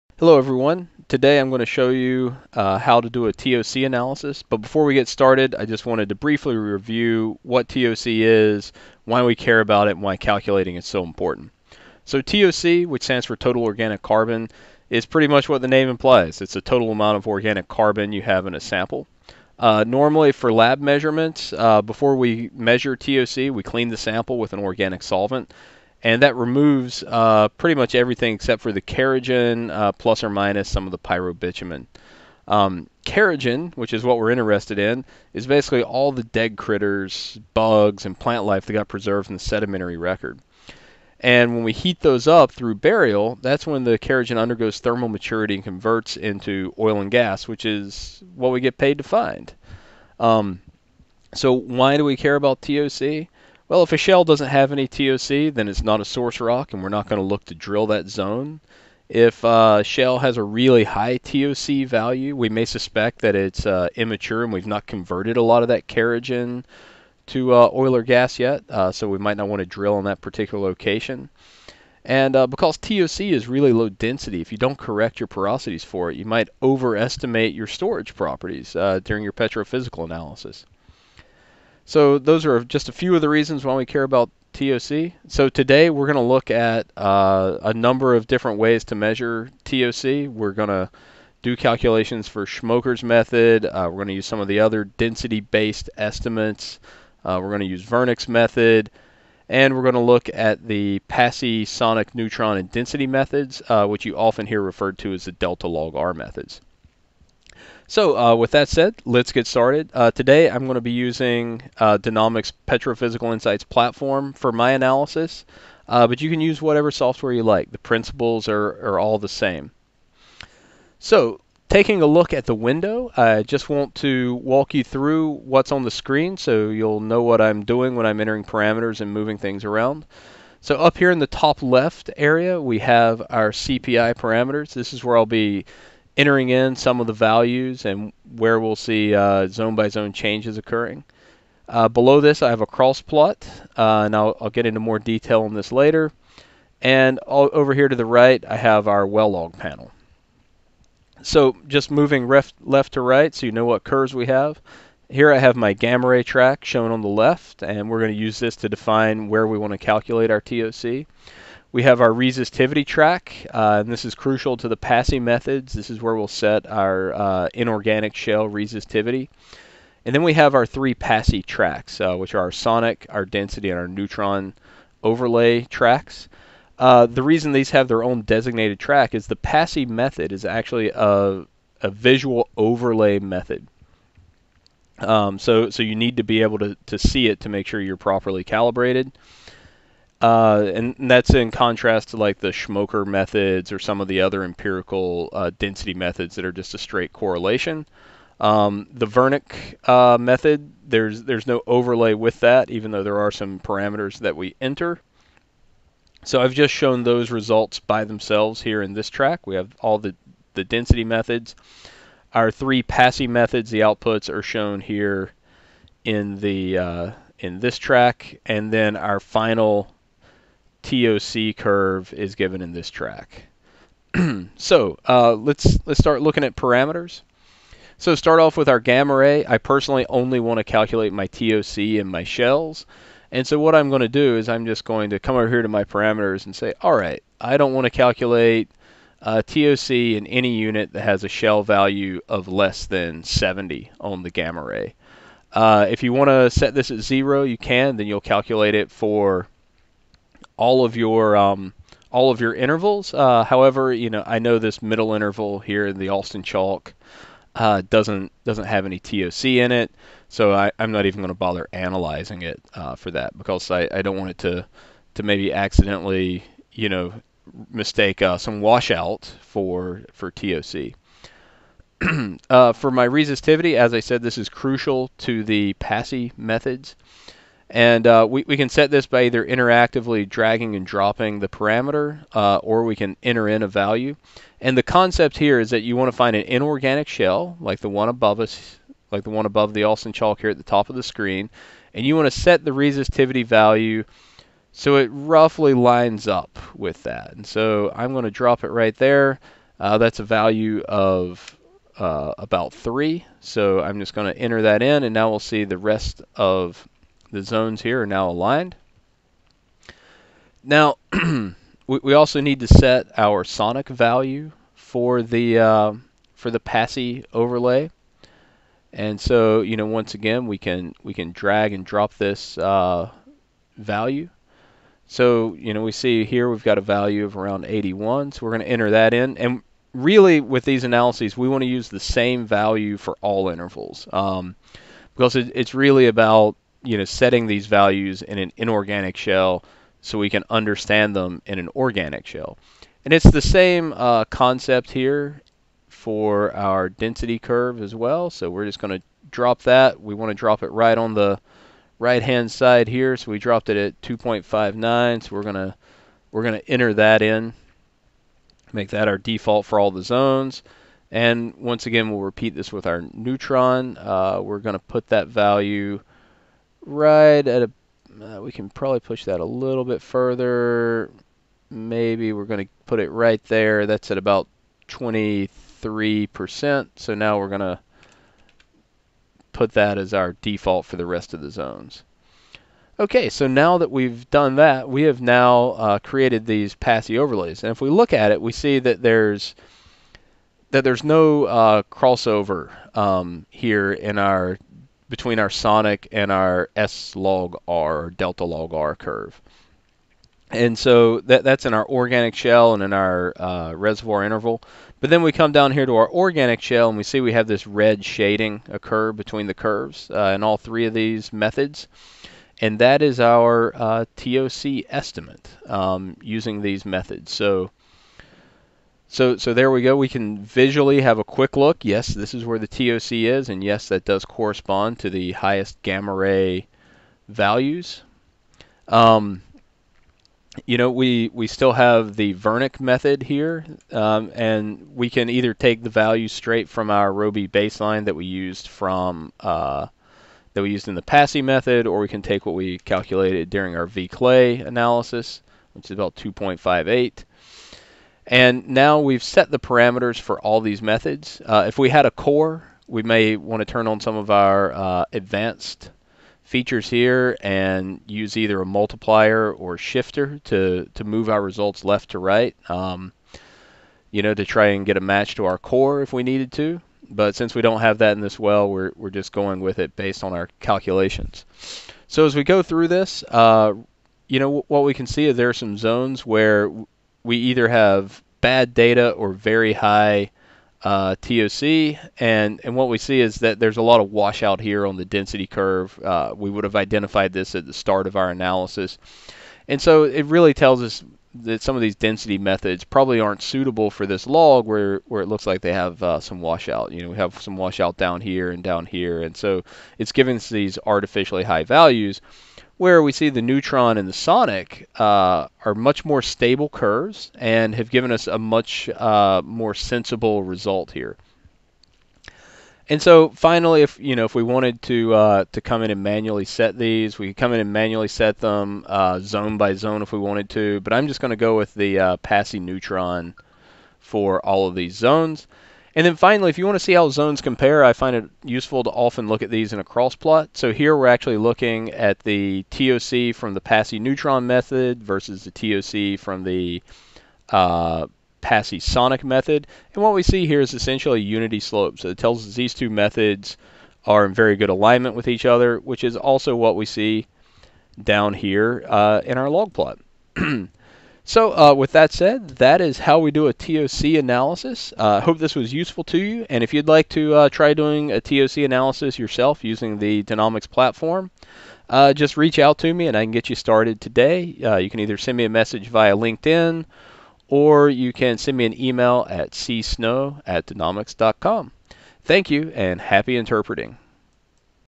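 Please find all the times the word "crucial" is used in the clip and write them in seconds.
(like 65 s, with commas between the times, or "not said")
164 s, 274 s.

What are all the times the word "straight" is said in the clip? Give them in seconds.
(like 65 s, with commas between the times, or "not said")
196 s, 436 s.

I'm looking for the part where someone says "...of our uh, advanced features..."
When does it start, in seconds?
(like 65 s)
454 s.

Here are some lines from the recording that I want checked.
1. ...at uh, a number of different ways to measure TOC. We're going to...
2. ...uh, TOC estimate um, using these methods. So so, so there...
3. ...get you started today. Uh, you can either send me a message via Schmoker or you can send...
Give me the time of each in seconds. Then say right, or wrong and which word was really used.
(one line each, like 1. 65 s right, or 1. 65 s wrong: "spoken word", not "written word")
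1. 86 s right
2. 413 s right
3. 563 s wrong: "LinkedIn", not "Schmoker".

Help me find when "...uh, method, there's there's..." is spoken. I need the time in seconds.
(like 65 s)
199 s.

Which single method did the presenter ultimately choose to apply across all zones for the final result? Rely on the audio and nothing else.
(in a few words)
Passey neutron.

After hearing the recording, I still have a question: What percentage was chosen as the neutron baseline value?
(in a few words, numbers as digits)
23%.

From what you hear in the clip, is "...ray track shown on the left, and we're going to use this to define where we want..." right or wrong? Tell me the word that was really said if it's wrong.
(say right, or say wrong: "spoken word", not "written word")
right.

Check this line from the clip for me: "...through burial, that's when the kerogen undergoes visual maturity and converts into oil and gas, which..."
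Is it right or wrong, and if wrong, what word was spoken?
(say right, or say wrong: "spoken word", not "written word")
wrong: "thermal", not "visual".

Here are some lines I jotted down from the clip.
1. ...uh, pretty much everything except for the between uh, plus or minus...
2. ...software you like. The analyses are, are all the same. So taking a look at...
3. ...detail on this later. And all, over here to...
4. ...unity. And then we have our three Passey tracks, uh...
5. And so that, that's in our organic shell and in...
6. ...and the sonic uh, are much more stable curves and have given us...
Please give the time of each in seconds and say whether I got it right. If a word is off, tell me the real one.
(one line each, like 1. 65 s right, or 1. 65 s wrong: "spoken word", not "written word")
1. 27 s wrong: "kerogen", not "between"
2. 116 s wrong: "principles", not "analyses"
3. 144 s right
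4. 168 s wrong: "resistivity", not "unity"
5. 400 s right
6. 503 s right.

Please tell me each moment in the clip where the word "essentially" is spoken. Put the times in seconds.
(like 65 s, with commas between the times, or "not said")
540 s.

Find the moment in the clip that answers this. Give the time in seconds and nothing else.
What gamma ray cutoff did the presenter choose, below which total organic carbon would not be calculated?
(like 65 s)
243 s.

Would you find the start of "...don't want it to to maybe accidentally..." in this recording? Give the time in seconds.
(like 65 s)
264 s.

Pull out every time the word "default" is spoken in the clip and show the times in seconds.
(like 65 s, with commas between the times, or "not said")
359 s, 380 s.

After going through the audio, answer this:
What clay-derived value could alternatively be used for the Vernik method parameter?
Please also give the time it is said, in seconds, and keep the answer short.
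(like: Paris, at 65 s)
2.58, at 446 s.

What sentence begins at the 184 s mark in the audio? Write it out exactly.
Um, so, so you need to be able to, to see it to make sure you're properly calibrated.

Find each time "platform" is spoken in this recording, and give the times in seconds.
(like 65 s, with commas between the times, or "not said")
113 s, 560 s.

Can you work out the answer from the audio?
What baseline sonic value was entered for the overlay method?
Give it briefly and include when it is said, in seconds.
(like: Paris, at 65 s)
81, at 327 s.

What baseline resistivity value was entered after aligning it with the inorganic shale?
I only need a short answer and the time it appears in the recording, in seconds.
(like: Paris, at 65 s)
3, at 302 s.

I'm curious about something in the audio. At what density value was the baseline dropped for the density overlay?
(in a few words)
2.59.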